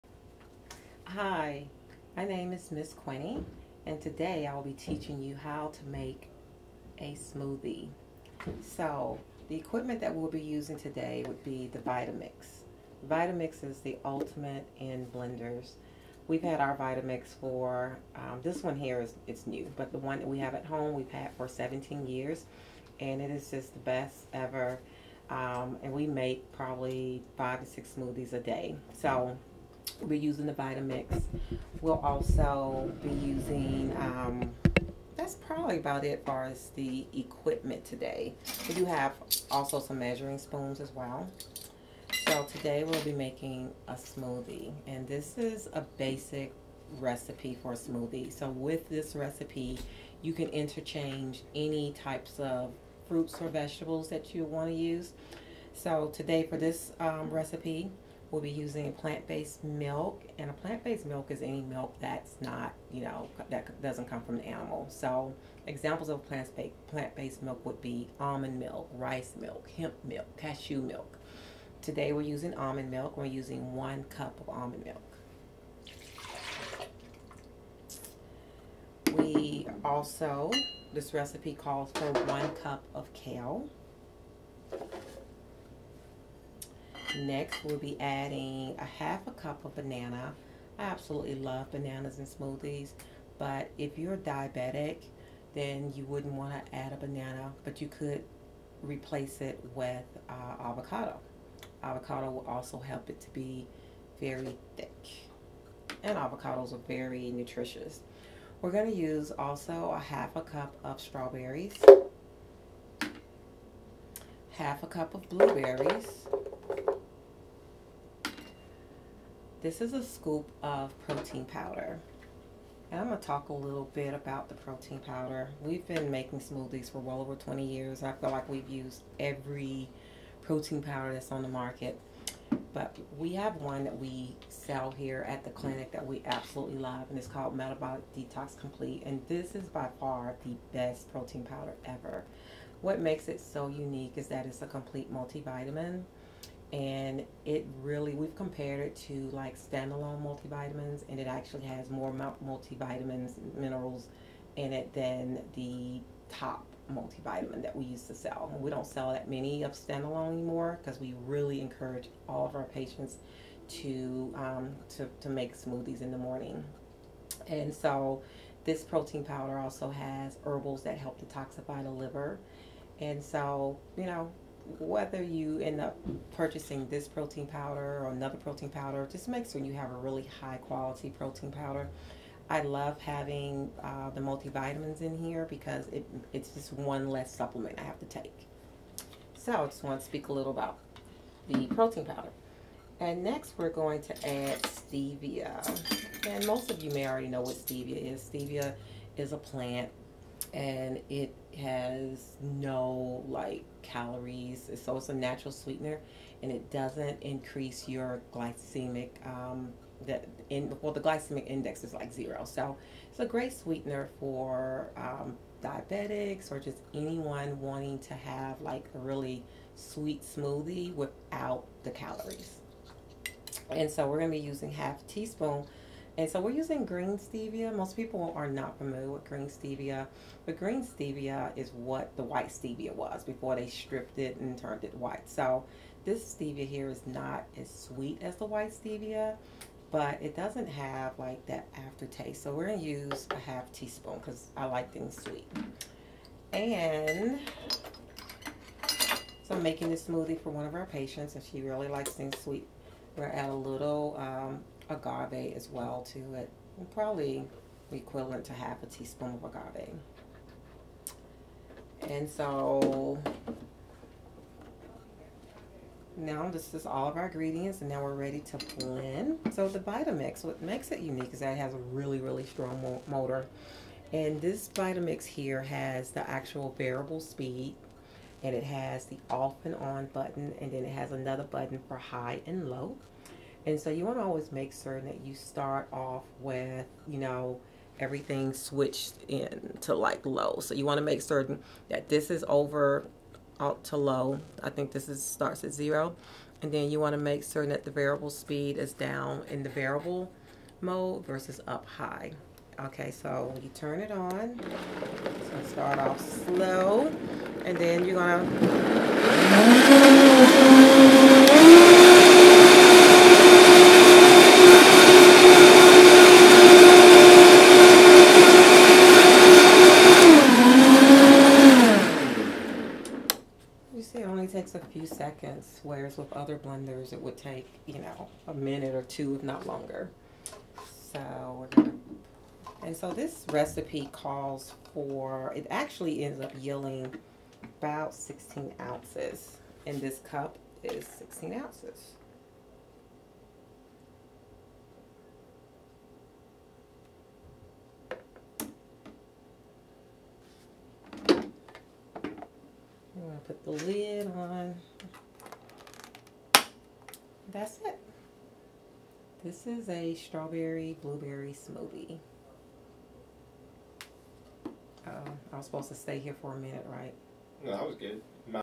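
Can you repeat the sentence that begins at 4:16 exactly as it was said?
Probably equivalent to half a teaspoon of agave.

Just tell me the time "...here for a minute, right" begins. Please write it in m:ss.
6:06.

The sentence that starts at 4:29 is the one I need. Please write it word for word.
So the Vitamix, what makes it unique is that it has a really, really strong motor.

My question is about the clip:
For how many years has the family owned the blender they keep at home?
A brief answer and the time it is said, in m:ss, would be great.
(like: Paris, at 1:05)
17 years, at 0:21.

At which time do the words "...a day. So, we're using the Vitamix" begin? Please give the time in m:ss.
0:28.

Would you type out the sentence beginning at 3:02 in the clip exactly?
I love having uh, the multivitamins in here because it, it's just one less supplement I have to take.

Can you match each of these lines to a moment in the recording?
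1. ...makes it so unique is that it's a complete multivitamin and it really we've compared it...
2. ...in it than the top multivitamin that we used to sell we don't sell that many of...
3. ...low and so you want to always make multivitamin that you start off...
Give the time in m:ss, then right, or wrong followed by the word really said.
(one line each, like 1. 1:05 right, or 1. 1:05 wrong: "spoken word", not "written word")
1. 2:22 right
2. 2:34 right
3. 4:42 wrong: "certain", not "multivitamin".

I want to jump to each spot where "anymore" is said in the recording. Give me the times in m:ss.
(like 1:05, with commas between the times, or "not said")
2:40.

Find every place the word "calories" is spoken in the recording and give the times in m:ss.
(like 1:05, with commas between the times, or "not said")
3:23, 3:41.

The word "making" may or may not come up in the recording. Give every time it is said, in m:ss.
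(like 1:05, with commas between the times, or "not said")
0:43, 2:06, 4:09.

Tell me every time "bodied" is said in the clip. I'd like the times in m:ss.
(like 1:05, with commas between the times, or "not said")
not said.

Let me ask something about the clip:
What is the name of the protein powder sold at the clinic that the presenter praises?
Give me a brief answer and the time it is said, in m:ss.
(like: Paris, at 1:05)
Metabolic Detox Complete, at 2:17.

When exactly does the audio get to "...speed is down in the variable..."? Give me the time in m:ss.
4:58.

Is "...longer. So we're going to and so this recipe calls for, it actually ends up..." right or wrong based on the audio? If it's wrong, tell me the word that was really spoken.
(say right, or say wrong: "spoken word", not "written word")
right.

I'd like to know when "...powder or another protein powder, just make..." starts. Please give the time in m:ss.
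2:57.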